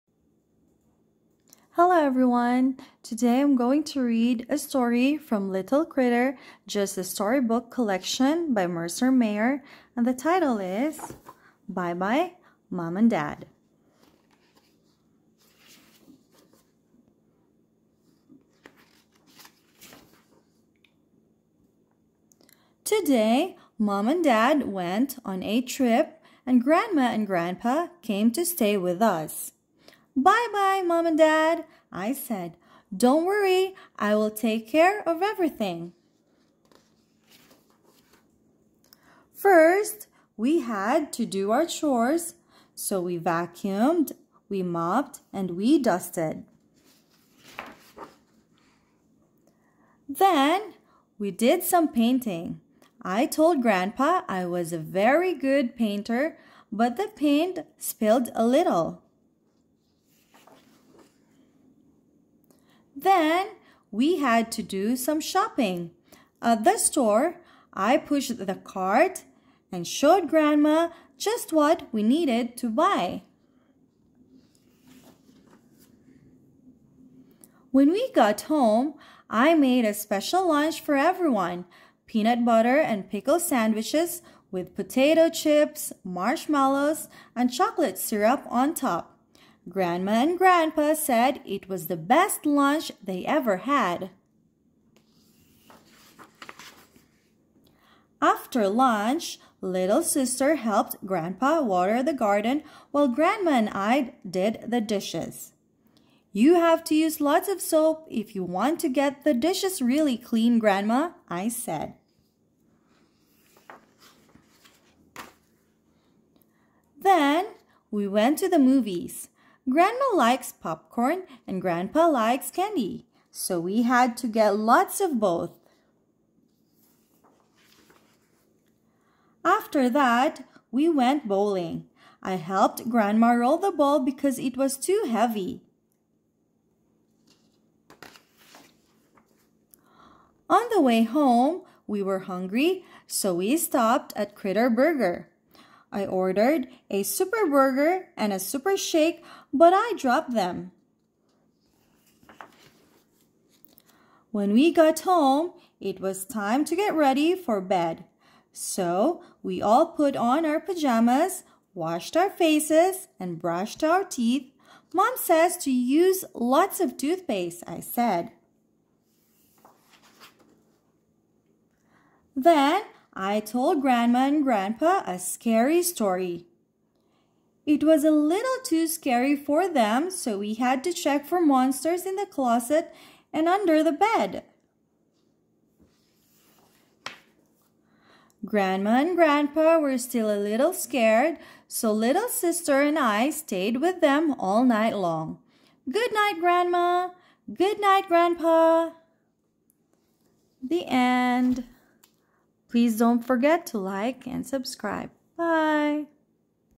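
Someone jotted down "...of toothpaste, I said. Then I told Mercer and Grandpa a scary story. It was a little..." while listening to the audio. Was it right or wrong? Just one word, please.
wrong.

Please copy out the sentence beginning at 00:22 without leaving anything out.
Today, Mom and Dad went on a trip and Grandma and Grandpa came to stay with us.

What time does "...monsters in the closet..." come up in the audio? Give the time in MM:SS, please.
03:01.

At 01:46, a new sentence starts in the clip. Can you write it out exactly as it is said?
You have to use lots of soap if you want to get the dishes really clean, Grandma, I said.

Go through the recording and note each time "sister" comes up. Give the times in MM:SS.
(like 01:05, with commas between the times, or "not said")
01:40, 03:12.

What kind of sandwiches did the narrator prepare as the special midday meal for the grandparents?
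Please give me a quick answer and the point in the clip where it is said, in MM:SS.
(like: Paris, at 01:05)
Peanut butter and pickle, at 01:22.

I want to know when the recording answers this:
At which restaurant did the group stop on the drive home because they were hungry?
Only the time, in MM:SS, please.
02:24.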